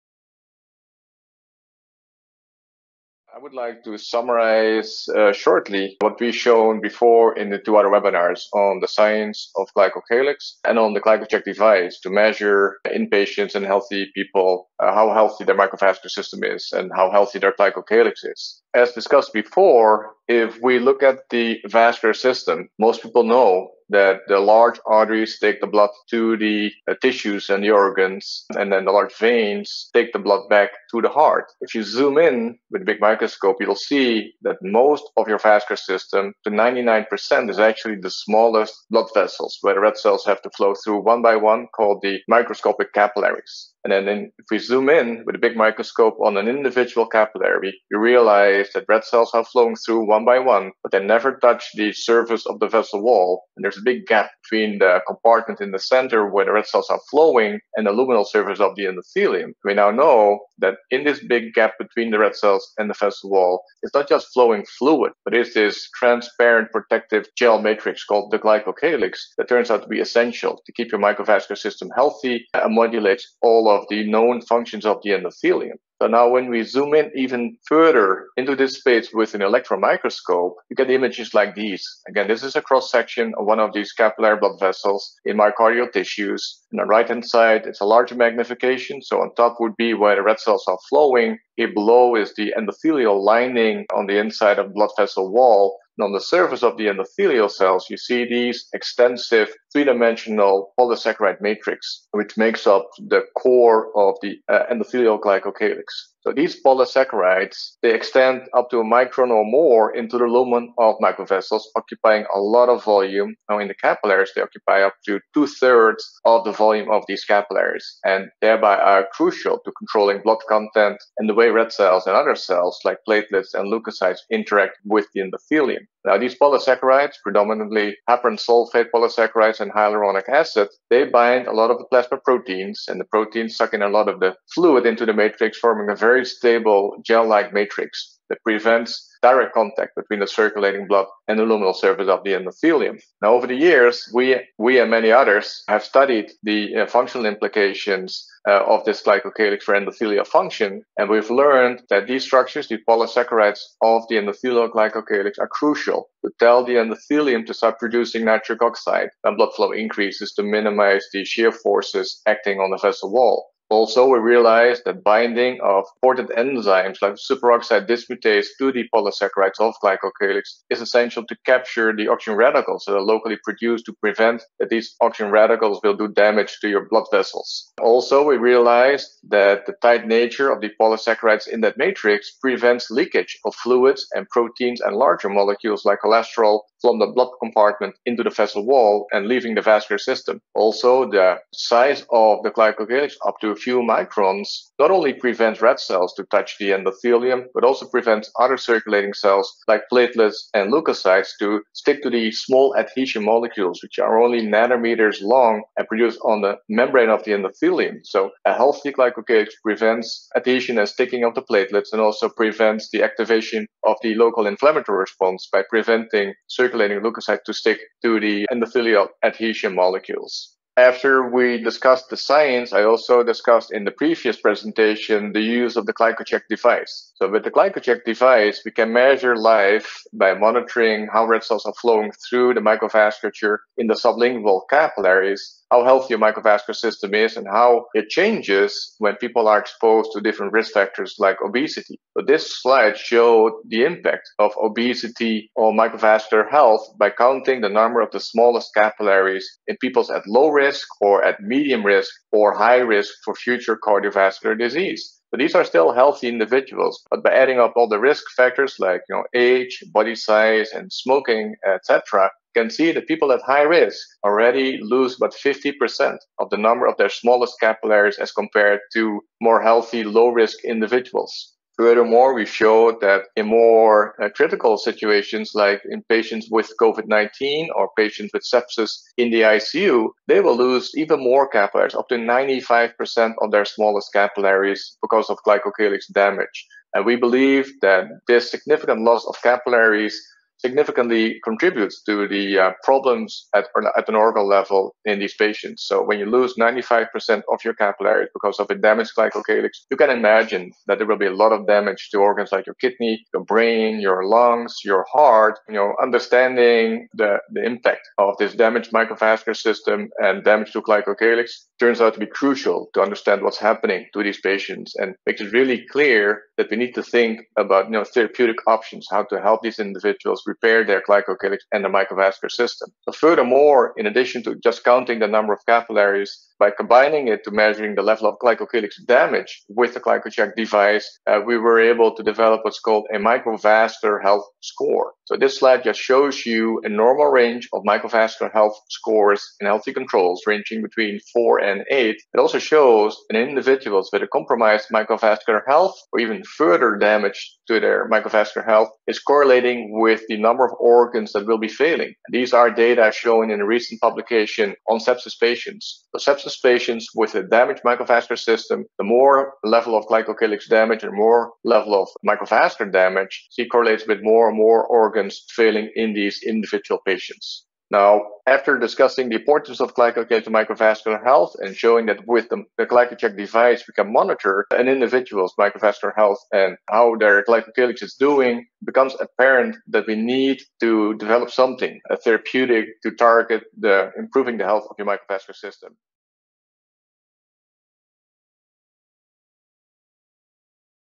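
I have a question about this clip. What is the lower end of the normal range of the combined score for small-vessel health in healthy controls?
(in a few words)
4.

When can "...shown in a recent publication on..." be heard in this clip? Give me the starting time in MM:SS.
05:53.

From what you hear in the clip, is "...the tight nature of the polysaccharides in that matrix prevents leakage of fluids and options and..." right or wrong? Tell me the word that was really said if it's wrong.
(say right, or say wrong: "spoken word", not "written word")
wrong: "proteins", not "options".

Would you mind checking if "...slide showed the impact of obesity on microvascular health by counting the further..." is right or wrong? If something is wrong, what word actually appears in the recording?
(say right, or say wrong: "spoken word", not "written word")
wrong: "number", not "further".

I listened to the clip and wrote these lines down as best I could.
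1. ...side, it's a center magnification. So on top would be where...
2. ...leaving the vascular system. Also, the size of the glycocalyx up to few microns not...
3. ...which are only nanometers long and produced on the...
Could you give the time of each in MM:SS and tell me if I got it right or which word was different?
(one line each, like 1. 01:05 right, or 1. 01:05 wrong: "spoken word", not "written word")
1. 01:27 wrong: "larger", not "center"
2. 03:09 right
3. 03:23 right.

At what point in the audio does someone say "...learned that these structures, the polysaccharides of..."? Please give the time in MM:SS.
02:31.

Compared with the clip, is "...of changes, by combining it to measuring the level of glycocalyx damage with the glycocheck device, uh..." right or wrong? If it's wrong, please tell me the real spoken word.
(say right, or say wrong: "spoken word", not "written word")
wrong: "capillaries", not "changes".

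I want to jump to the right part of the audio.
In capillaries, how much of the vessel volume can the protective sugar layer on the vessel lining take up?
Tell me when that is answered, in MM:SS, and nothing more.
01:55.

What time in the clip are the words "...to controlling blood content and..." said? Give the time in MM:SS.
01:59.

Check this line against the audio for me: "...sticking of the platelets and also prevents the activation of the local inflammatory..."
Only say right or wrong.
right.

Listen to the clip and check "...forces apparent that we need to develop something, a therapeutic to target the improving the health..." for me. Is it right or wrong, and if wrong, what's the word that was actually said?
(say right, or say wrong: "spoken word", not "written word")
wrong: "becomes", not "forces".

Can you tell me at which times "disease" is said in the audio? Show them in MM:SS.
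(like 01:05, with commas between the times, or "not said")
04:14.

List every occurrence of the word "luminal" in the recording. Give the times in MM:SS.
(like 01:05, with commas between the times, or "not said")
00:57, 02:21.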